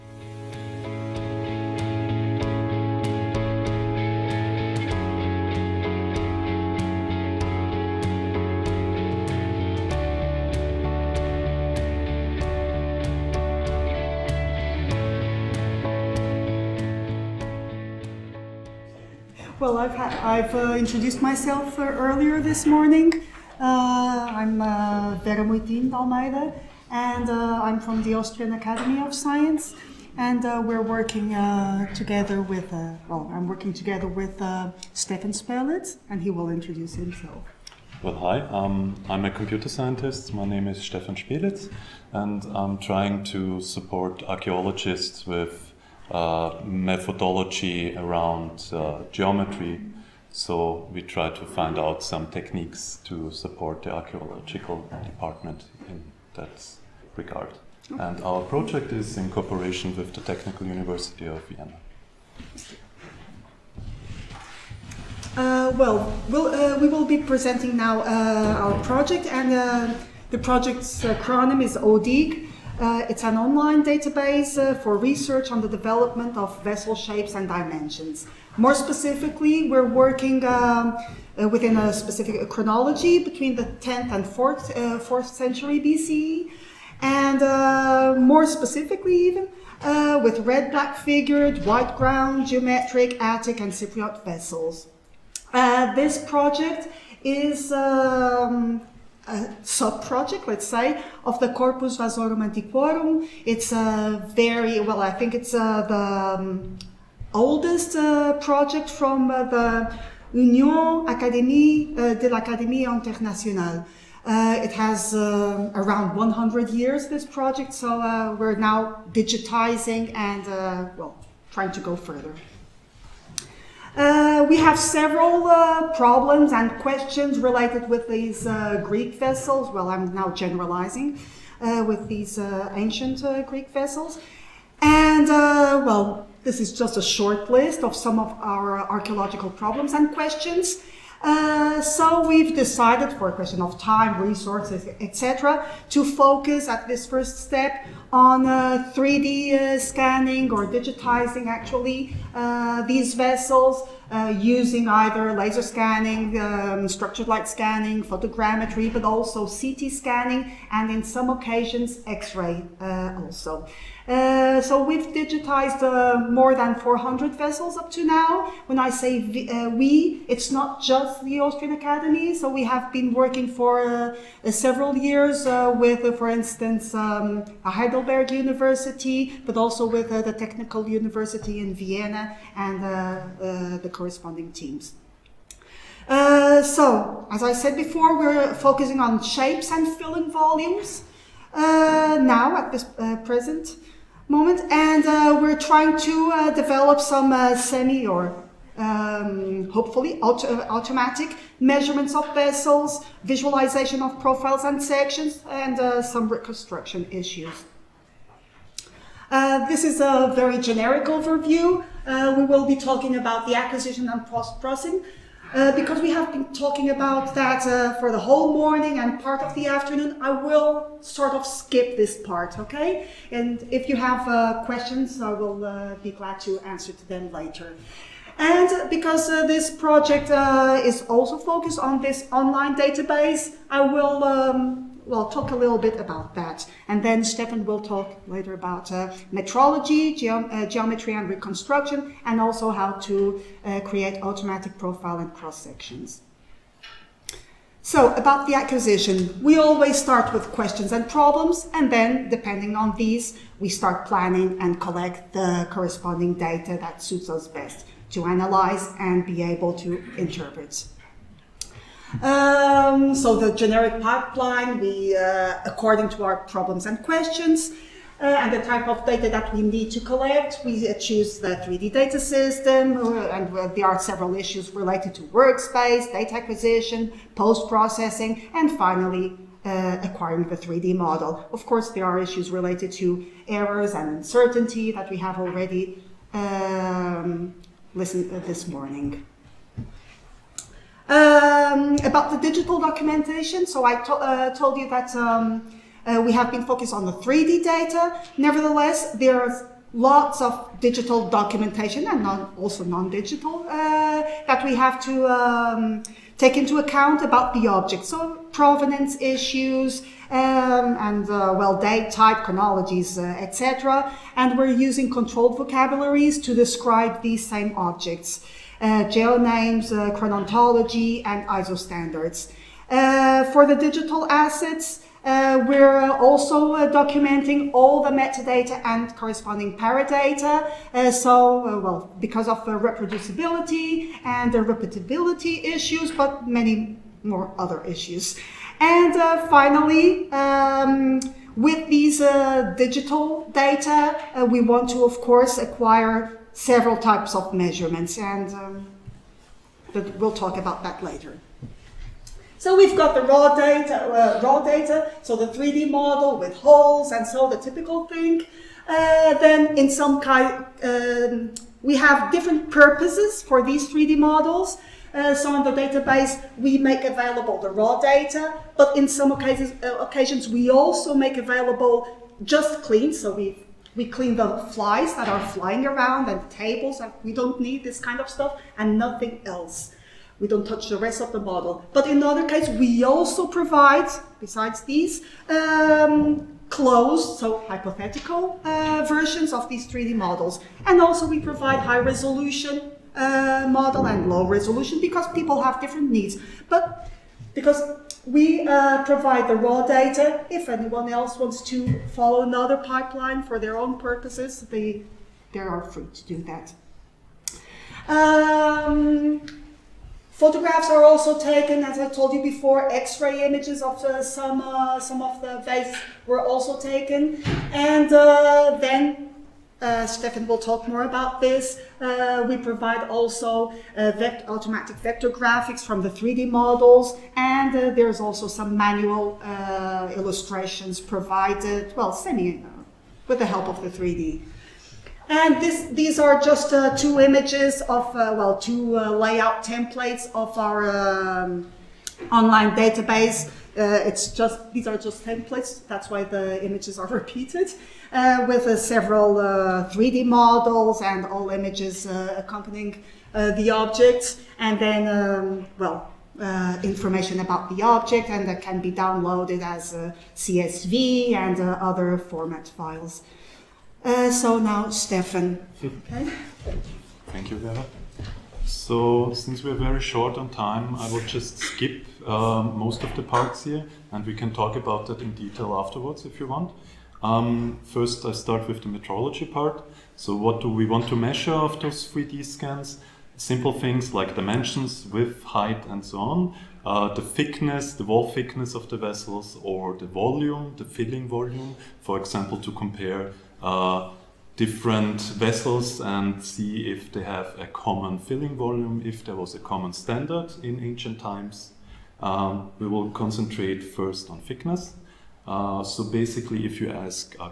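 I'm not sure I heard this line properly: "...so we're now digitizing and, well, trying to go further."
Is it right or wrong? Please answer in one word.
right.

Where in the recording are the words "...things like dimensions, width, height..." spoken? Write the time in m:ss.
8:03.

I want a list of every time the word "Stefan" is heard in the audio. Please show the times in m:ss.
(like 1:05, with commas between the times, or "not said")
0:34, 0:40, 3:57, 7:00, 7:45.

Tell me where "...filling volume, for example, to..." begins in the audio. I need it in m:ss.
8:10.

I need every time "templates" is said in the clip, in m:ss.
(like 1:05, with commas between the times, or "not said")
7:19, 7:25.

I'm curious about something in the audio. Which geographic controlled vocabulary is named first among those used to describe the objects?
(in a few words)
GeoNames.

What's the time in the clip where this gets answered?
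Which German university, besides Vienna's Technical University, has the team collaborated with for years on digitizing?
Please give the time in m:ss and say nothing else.
2:57.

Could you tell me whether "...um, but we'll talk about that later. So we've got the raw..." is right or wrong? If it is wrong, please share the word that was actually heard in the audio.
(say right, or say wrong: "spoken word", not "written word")
right.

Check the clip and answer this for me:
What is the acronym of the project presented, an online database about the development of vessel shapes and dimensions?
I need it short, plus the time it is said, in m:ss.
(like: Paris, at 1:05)
ODIG, at 1:11.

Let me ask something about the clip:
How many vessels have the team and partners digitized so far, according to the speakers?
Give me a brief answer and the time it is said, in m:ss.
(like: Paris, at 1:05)
more than 400, at 2:46.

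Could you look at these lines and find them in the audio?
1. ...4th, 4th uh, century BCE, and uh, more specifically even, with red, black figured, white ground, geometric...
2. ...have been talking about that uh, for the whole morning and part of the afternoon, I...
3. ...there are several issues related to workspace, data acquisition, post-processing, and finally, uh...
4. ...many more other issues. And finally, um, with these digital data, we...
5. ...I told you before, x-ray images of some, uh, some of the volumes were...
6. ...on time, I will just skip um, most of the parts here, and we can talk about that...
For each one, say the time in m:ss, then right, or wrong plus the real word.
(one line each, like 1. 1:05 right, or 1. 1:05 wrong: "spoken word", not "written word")
1. 1:24 right
2. 3:36 right
3. 4:33 right
4. 5:36 right
5. 6:51 wrong: "vases", not "volumes"
6. 7:50 right.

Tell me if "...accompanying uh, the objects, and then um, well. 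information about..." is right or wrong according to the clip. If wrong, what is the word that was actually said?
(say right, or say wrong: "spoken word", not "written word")
right.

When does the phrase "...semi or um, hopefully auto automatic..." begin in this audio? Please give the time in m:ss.
3:17.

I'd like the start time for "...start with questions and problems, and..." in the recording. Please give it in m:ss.
4:09.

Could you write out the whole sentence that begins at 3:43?
And if you have uh, questions, I will uh, be glad to answer to them later.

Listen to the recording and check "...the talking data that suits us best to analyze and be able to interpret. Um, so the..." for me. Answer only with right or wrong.
wrong.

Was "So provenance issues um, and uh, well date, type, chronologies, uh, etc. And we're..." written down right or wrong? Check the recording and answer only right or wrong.
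right.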